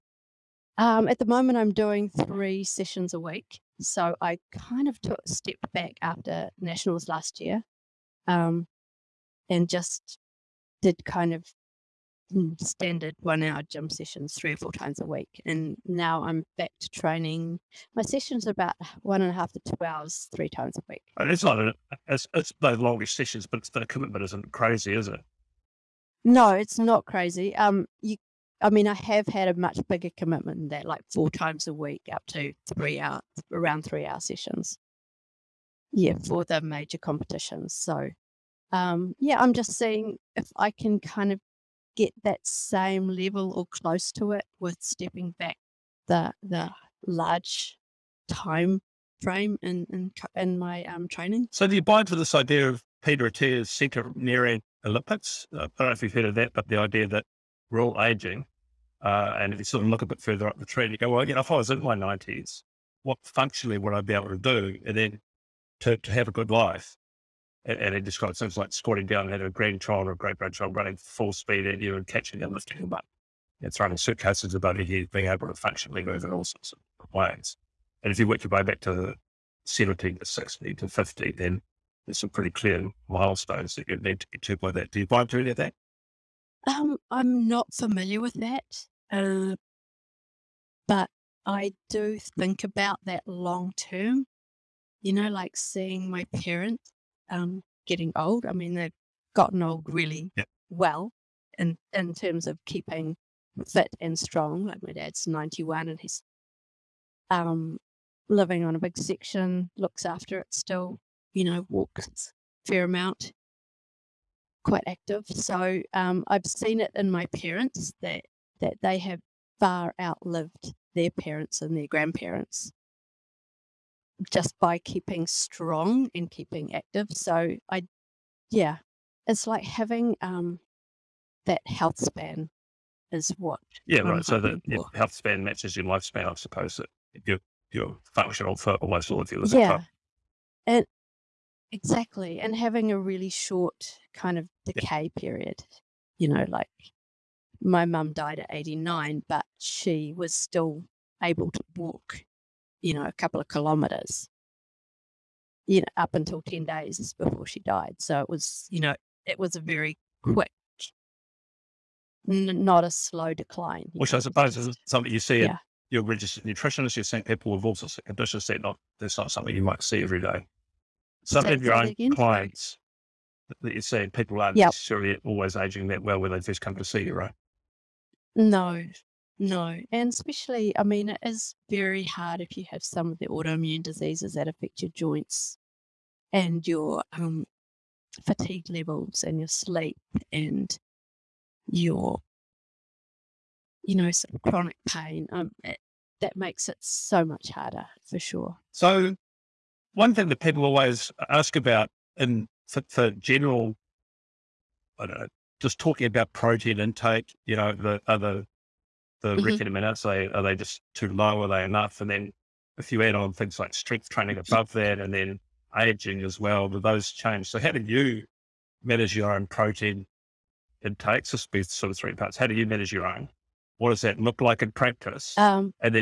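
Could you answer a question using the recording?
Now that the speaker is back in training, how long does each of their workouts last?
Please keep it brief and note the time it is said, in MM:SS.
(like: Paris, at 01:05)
1.5 to 2 hours, at 00:19.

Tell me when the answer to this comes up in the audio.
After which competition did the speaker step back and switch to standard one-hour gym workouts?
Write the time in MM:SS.
00:06.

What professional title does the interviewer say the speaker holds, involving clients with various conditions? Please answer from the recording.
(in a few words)
registered nutritionist.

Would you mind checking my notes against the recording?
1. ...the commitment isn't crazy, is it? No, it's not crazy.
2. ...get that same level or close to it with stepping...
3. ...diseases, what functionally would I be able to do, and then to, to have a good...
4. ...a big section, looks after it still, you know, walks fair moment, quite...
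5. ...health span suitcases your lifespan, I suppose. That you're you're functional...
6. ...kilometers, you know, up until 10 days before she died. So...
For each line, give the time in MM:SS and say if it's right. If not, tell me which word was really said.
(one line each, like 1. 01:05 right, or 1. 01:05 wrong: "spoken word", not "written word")
1. 00:23 right
2. 00:41 right
3. 01:01 wrong: "nineties", not "diseases"
4. 01:48 wrong: "amount", not "moment"
5. 02:14 wrong: "matches", not "suitcases"
6. 02:33 right.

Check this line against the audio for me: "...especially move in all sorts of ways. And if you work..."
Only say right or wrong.
wrong.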